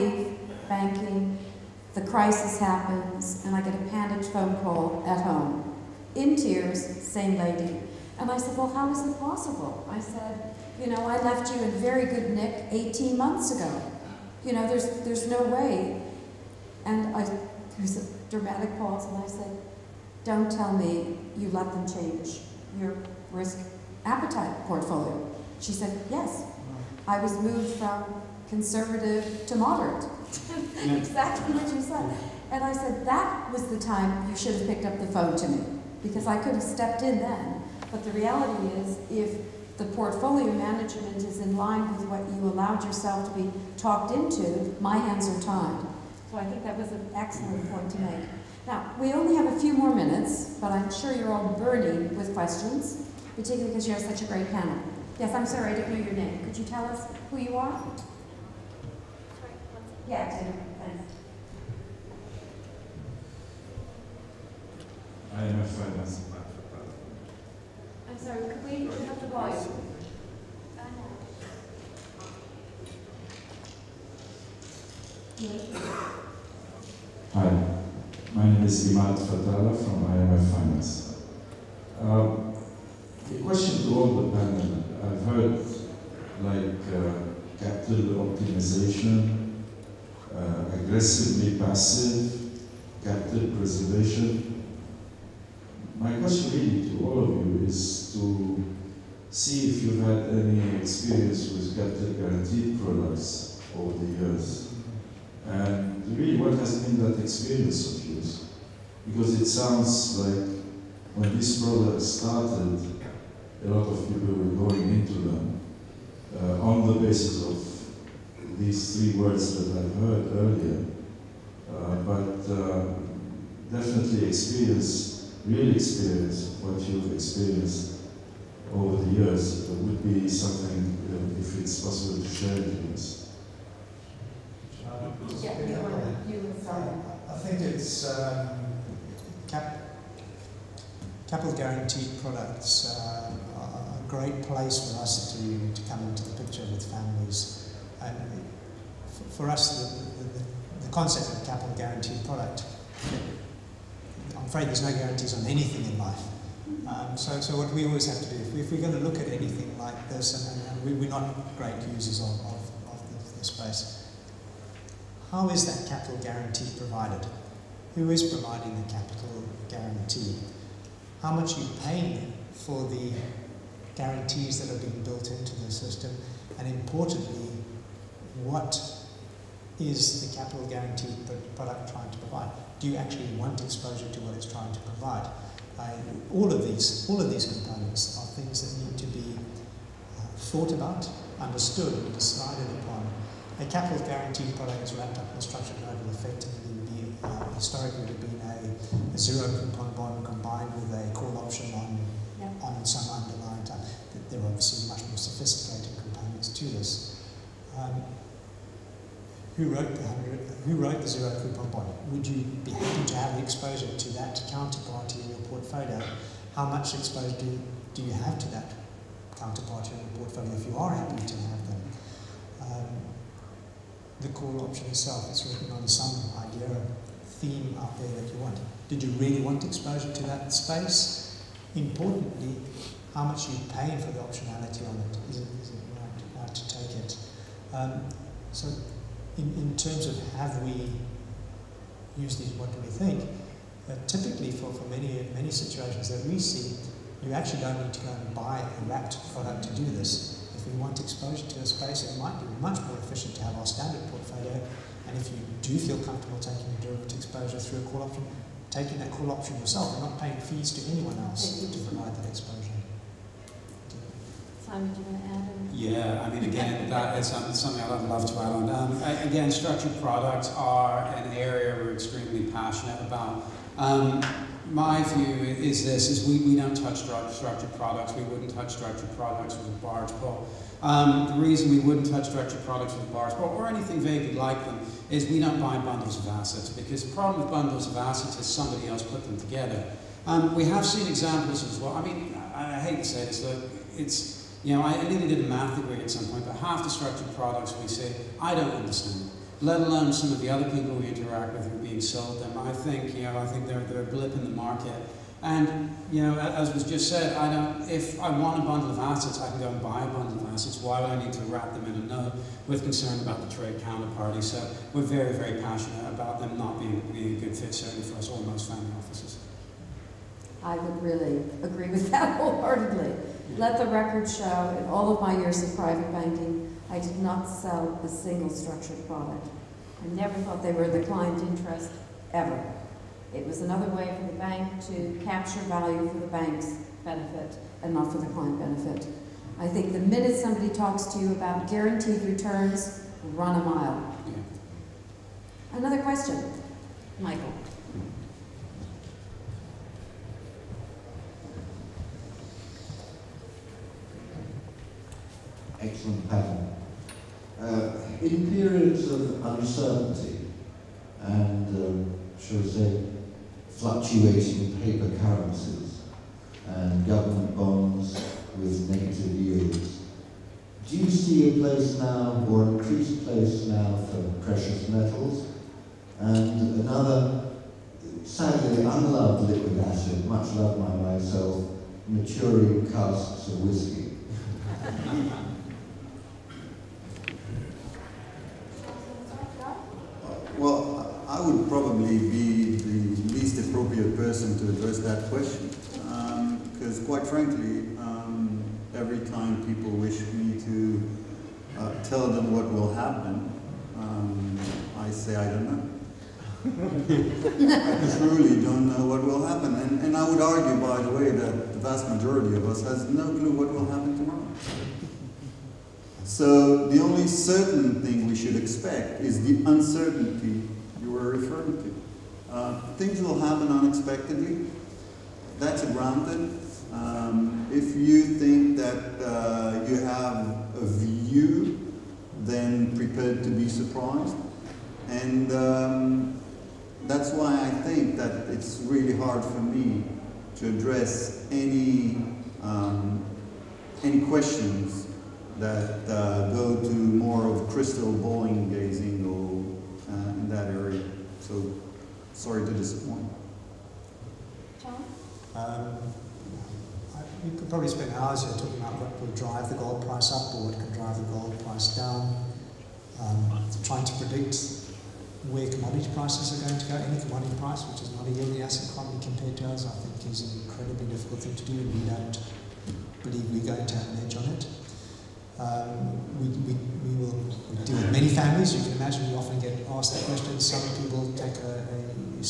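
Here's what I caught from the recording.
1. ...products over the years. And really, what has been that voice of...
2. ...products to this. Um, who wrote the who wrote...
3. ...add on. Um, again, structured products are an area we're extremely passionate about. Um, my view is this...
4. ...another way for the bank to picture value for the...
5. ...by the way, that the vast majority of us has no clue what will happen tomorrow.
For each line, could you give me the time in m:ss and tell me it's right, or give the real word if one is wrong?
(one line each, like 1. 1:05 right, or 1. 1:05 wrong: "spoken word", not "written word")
1. 1:42 wrong: "experience", not "voice"
2. 3:25 wrong: "components", not "products"
3. 4:28 right
4. 5:33 wrong: "capture", not "picture"
5. 6:50 right.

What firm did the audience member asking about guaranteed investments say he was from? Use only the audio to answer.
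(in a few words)
IMF Finance.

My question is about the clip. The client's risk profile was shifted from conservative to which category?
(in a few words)
moderate.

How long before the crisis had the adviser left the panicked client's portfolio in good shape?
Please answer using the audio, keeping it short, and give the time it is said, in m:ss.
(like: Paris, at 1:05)
18 months, at 0:12.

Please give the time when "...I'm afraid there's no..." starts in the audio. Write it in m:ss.
2:34.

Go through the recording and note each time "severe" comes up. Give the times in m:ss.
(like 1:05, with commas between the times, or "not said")
not said.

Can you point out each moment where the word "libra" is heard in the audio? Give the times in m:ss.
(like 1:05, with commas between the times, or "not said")
not said.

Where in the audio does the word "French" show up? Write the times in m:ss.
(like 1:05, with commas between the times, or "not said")
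not said.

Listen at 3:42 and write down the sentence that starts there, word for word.
Um, the call option itself is written on some idea theme out there that you want.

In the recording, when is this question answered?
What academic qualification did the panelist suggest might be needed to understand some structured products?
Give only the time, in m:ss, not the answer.
4:55.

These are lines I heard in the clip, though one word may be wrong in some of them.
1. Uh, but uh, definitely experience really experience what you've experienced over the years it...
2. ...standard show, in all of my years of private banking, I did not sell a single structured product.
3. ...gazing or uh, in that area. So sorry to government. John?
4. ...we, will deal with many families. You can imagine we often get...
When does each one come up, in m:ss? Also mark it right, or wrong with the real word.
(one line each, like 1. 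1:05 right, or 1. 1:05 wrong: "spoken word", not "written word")
1. 2:01 right
2. 5:23 wrong: "record", not "standard"
3. 7:28 wrong: "disappoint", not "government"
4. 7:57 right.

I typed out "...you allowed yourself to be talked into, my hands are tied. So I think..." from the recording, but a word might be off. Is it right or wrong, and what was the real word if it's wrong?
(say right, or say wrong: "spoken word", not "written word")
right.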